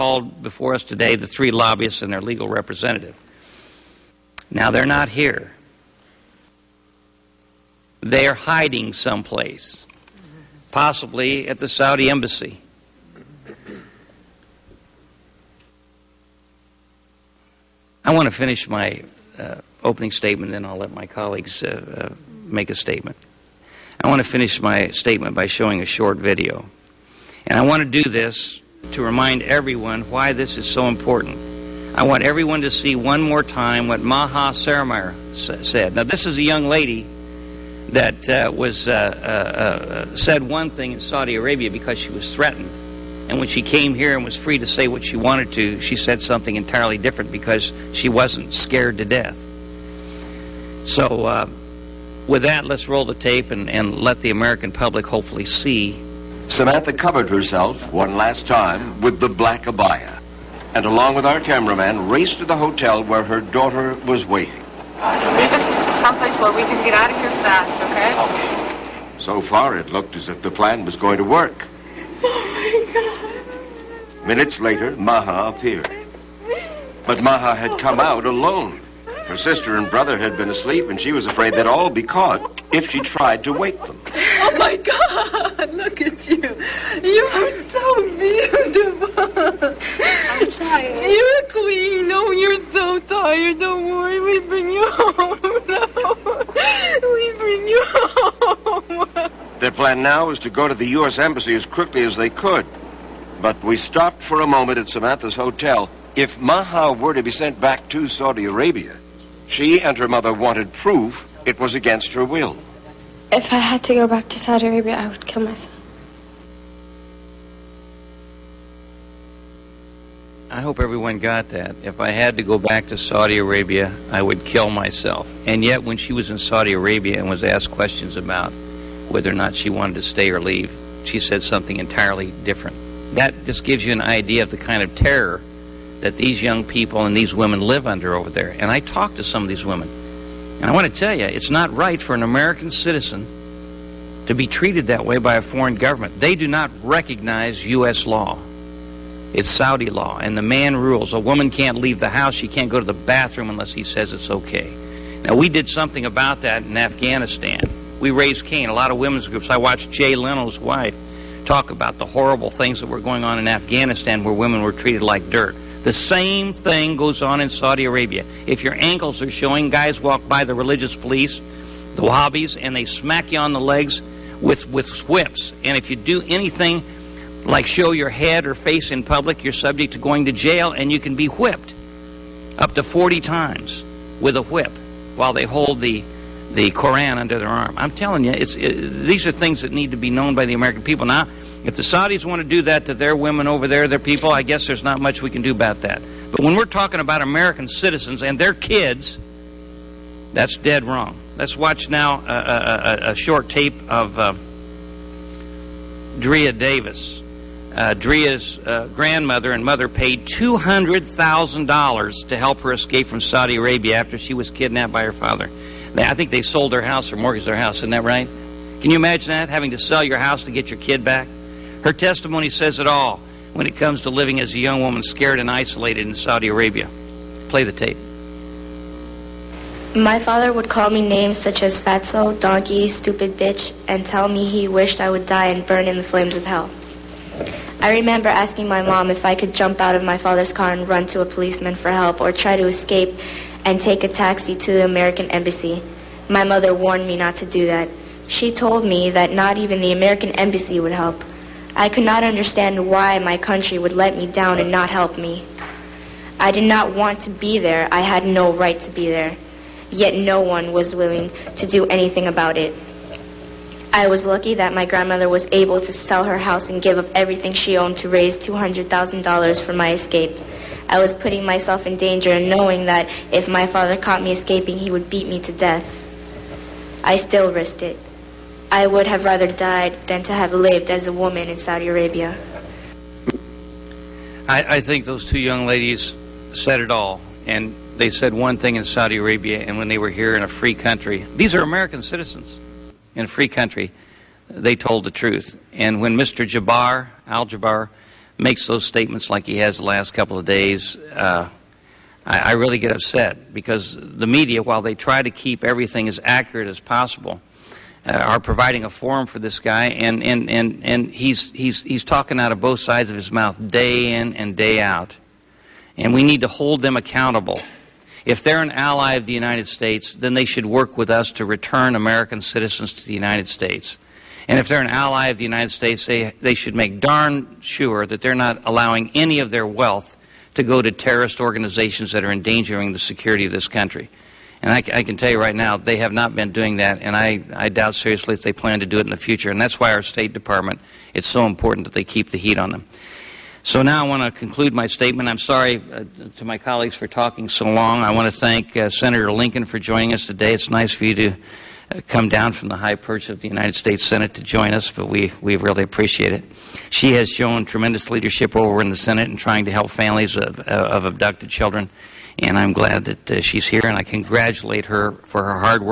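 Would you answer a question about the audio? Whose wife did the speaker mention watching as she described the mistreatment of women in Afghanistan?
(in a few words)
Jay Leno.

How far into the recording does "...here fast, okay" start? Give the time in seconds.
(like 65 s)
67 s.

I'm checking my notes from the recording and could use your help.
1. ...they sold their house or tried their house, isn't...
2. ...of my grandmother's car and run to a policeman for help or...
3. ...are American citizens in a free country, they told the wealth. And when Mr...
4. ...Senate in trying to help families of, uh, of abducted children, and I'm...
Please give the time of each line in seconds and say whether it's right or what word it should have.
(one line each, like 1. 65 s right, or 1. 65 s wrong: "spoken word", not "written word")
1. 216 s wrong: "mortgaged", not "tried"
2. 239 s wrong: "father", not "grandmother"
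3. 291 s wrong: "truth", not "wealth"
4. 358 s right.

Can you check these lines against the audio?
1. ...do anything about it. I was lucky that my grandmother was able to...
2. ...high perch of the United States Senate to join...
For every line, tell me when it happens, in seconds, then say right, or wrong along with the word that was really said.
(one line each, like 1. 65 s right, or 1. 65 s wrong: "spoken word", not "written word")
1. 261 s right
2. 352 s right.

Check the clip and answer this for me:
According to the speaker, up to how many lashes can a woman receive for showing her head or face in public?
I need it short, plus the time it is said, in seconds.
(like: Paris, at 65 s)
40, at 182 s.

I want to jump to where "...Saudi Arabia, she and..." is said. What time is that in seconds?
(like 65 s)
108 s.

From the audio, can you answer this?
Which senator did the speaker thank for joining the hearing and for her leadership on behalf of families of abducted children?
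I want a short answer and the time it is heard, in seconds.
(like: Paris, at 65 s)
Senator Lincoln, at 348 s.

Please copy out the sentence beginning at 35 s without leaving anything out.
Now, this is a young lady that uh, was uh, uh, uh, said one thing in Saudi Arabia because she was threatened.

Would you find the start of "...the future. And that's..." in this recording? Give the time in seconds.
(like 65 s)
339 s.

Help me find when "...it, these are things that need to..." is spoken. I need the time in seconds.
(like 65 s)
188 s.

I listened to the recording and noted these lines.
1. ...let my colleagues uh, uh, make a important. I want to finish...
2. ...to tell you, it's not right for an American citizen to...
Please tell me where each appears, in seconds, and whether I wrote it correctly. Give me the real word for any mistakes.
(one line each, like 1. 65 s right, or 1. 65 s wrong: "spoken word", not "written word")
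1. 20 s wrong: "statement", not "important"
2. 140 s right.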